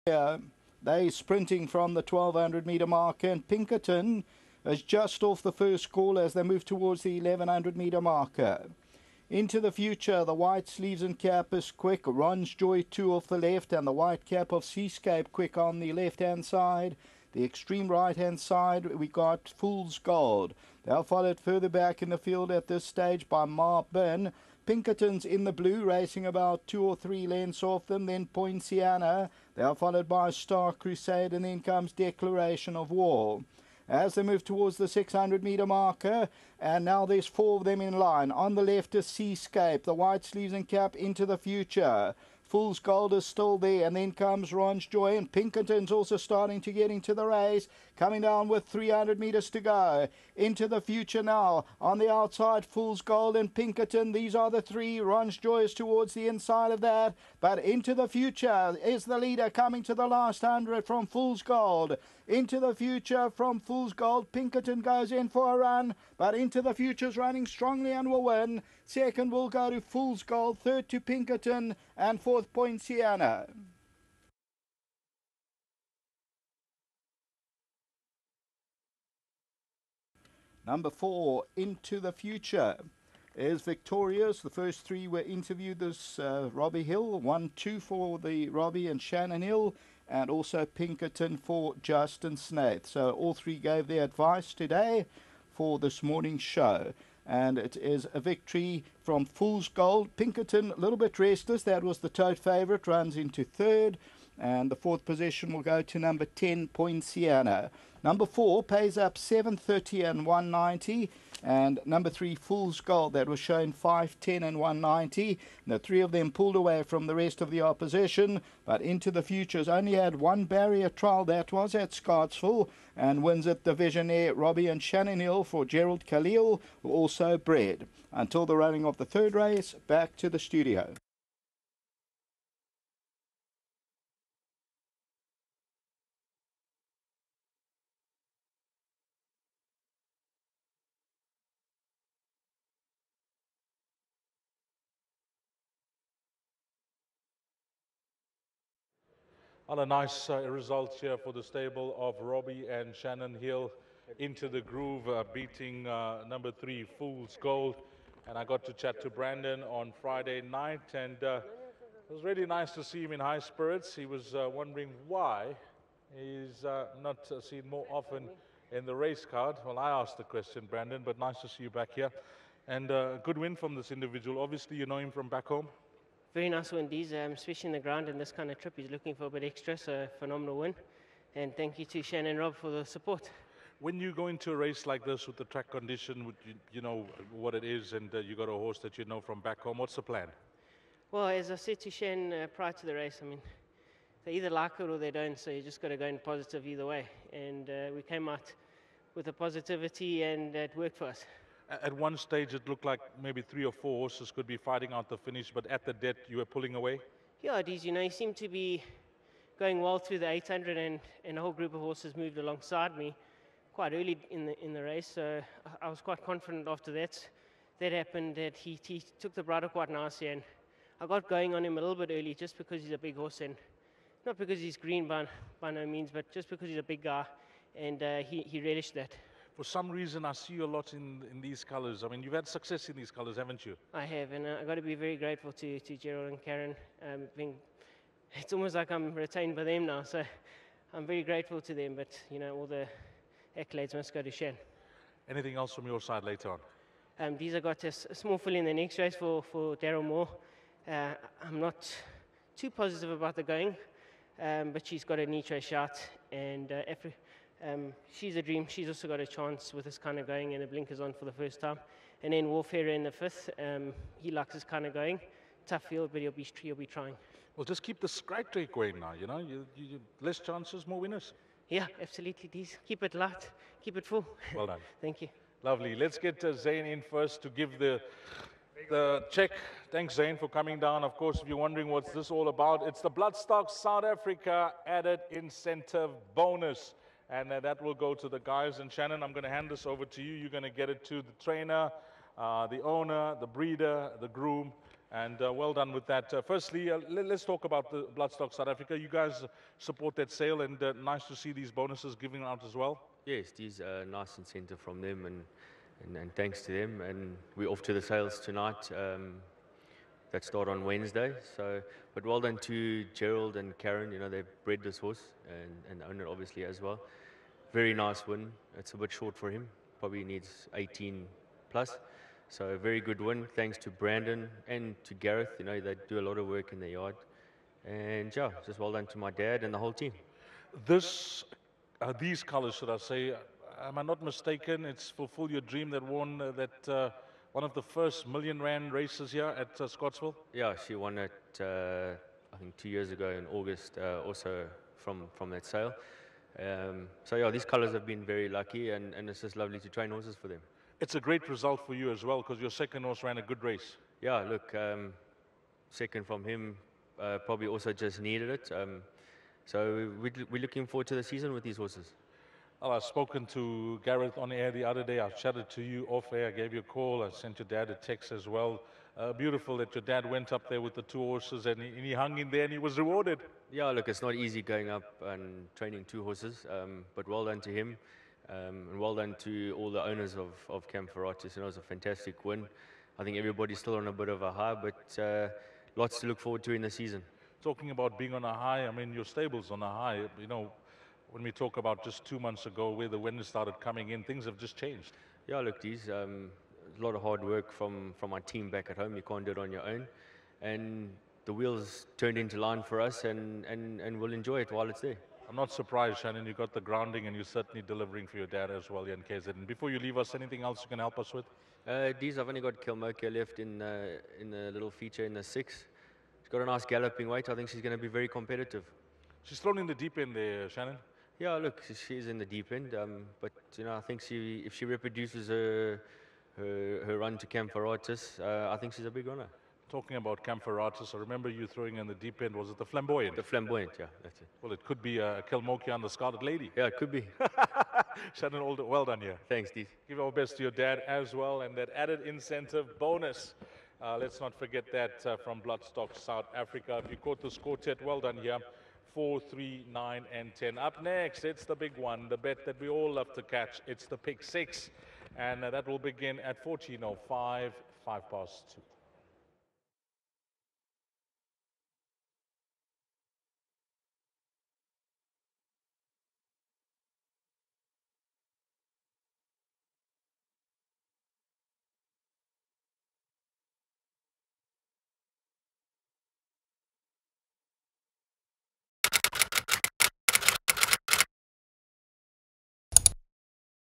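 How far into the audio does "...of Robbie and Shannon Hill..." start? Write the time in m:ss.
2:31.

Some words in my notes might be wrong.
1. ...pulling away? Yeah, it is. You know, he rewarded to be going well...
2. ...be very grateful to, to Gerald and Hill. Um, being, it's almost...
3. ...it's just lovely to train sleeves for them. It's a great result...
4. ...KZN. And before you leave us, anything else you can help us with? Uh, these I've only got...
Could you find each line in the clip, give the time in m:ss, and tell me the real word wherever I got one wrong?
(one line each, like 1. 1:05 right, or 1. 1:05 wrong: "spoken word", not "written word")
1. 3:26 wrong: "seemed", not "rewarded"
2. 3:54 wrong: "Karen", not "Hill"
3. 5:49 wrong: "horses", not "sleeves"
4. 6:49 right.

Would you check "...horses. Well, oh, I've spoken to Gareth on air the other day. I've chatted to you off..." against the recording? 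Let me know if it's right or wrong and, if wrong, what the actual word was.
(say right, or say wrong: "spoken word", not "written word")
right.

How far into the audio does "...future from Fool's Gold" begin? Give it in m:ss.
1:02.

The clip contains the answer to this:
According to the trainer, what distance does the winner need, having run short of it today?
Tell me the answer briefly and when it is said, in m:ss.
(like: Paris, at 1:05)
18 plus, at 5:20.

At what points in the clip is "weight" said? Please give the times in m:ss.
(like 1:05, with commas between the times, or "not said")
6:57.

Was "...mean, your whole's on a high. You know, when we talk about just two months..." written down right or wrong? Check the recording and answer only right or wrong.
wrong.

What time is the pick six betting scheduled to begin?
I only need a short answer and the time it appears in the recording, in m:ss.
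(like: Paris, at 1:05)
14:05, at 7:36.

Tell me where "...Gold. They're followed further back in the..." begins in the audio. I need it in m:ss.
0:19.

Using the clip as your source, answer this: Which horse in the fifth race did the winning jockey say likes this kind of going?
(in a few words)
Warfare.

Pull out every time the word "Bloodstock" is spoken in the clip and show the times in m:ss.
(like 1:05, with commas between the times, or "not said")
4:43, 4:58, 7:25.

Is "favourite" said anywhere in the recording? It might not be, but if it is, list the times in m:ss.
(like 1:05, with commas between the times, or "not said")
1:42.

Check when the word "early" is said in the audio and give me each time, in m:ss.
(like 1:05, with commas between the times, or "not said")
3:33, 3:42.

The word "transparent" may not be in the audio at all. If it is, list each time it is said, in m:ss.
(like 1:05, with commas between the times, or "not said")
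not said.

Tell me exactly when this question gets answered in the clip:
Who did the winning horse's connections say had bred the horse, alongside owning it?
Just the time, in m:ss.
2:05.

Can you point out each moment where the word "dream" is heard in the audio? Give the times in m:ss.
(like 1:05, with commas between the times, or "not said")
4:18, 5:35.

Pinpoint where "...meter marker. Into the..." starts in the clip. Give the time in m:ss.
0:07.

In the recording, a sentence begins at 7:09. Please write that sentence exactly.
Talking about Camphoritis, I remember you throwing in the deep end.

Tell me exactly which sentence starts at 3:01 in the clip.
And thank you to Shannon Rob for the support.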